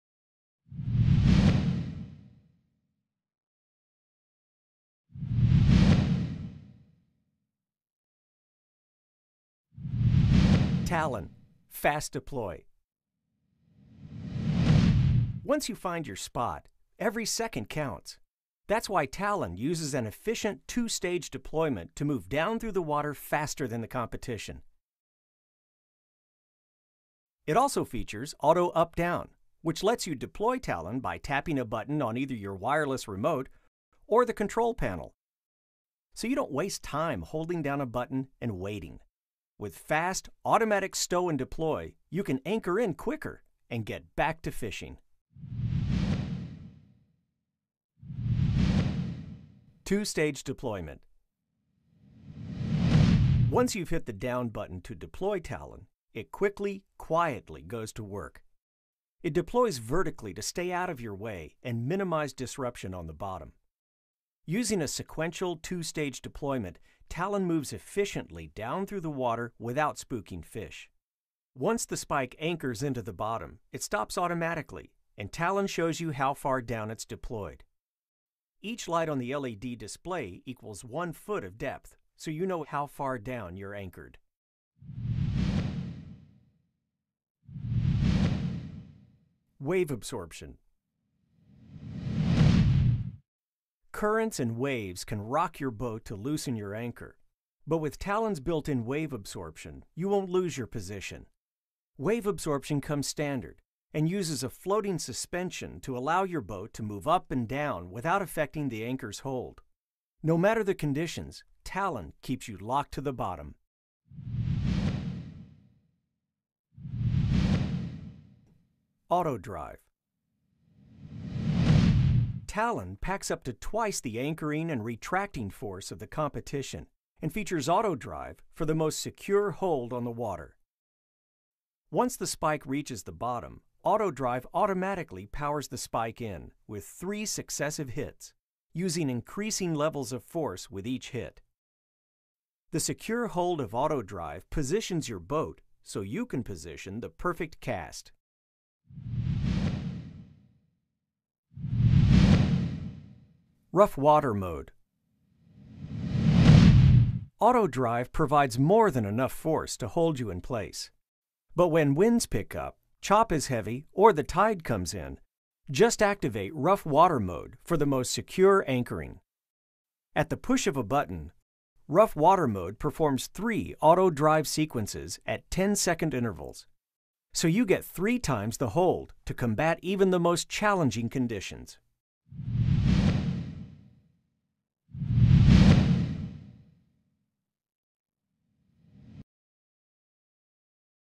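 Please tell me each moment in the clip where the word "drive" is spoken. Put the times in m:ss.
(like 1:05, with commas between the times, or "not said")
1:59, 2:07, 2:14, 2:24, 2:37, 2:54.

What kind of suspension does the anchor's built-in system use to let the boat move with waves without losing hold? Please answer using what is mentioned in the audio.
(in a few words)
floating suspension.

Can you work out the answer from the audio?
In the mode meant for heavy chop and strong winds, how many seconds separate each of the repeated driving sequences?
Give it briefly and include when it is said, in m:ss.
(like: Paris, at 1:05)
10 seconds, at 2:55.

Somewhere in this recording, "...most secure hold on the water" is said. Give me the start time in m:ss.
2:08.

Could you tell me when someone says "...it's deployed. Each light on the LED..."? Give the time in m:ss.
1:16.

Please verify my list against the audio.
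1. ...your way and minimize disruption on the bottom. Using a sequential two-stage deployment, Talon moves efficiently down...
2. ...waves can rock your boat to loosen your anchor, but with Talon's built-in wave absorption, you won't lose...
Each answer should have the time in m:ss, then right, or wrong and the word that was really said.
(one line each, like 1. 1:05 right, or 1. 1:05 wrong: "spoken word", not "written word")
1. 1:00 right
2. 1:34 right.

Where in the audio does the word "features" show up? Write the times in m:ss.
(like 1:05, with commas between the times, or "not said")
0:27, 2:07.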